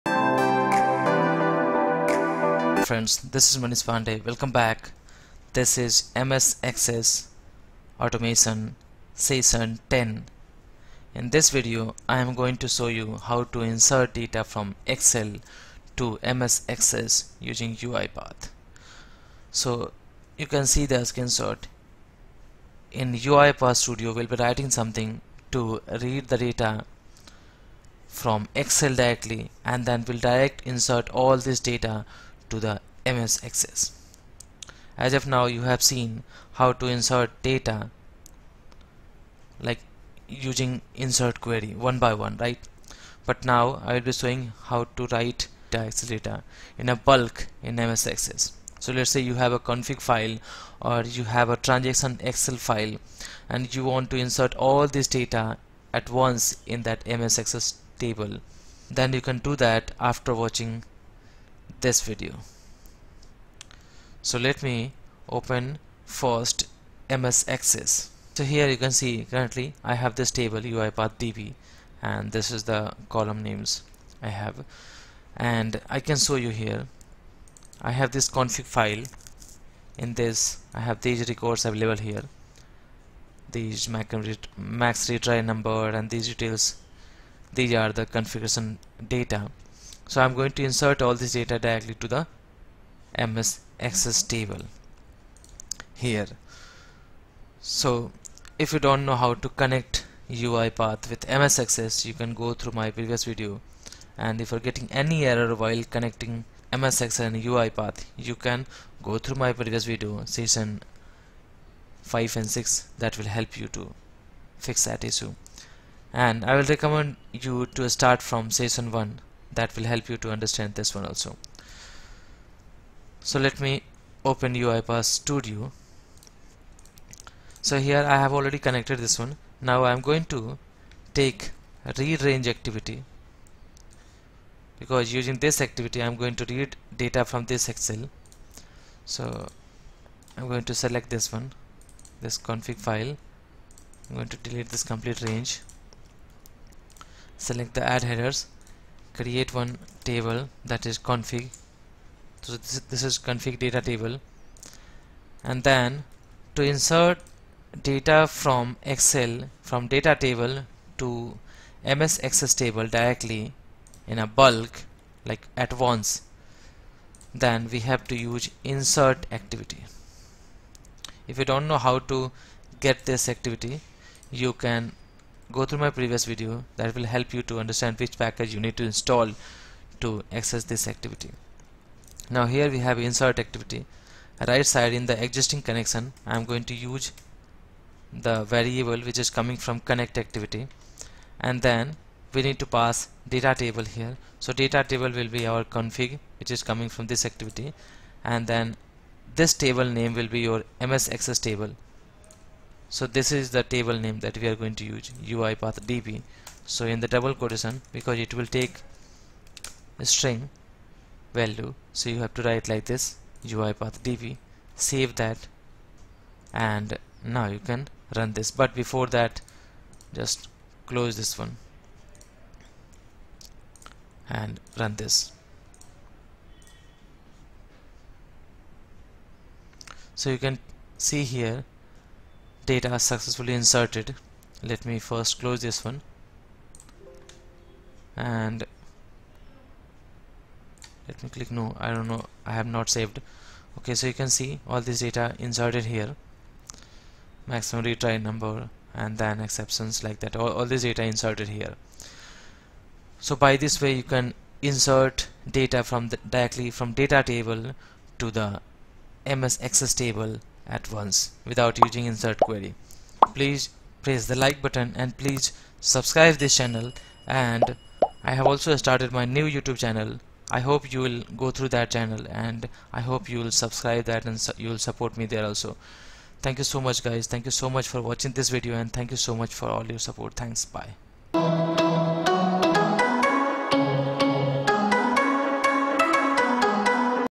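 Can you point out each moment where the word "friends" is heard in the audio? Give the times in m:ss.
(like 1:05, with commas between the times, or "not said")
0:02.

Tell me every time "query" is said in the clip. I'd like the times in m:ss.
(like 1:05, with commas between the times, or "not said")
0:41, 4:22.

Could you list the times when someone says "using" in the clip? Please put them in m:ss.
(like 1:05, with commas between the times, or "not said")
0:17, 0:40, 2:15, 4:21.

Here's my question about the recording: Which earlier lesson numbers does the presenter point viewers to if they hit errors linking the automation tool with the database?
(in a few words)
Sessions 5 and 6.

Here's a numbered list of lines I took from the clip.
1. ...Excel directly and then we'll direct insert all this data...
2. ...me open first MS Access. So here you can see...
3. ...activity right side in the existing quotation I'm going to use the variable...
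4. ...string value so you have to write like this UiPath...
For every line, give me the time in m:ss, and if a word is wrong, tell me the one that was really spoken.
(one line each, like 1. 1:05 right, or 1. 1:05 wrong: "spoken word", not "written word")
1. 0:28 right
2. 1:04 right
3. 3:03 wrong: "connection", not "quotation"
4. 3:30 right.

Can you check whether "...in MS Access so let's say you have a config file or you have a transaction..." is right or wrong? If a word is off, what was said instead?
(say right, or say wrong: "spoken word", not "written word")
right.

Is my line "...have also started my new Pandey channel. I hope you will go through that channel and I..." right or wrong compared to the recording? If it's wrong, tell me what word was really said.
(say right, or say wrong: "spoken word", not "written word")
wrong: "YouTube", not "Pandey".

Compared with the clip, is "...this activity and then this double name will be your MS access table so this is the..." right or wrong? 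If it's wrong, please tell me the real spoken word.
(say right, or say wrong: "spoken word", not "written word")
wrong: "table", not "double".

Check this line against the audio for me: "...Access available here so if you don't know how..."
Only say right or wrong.
wrong.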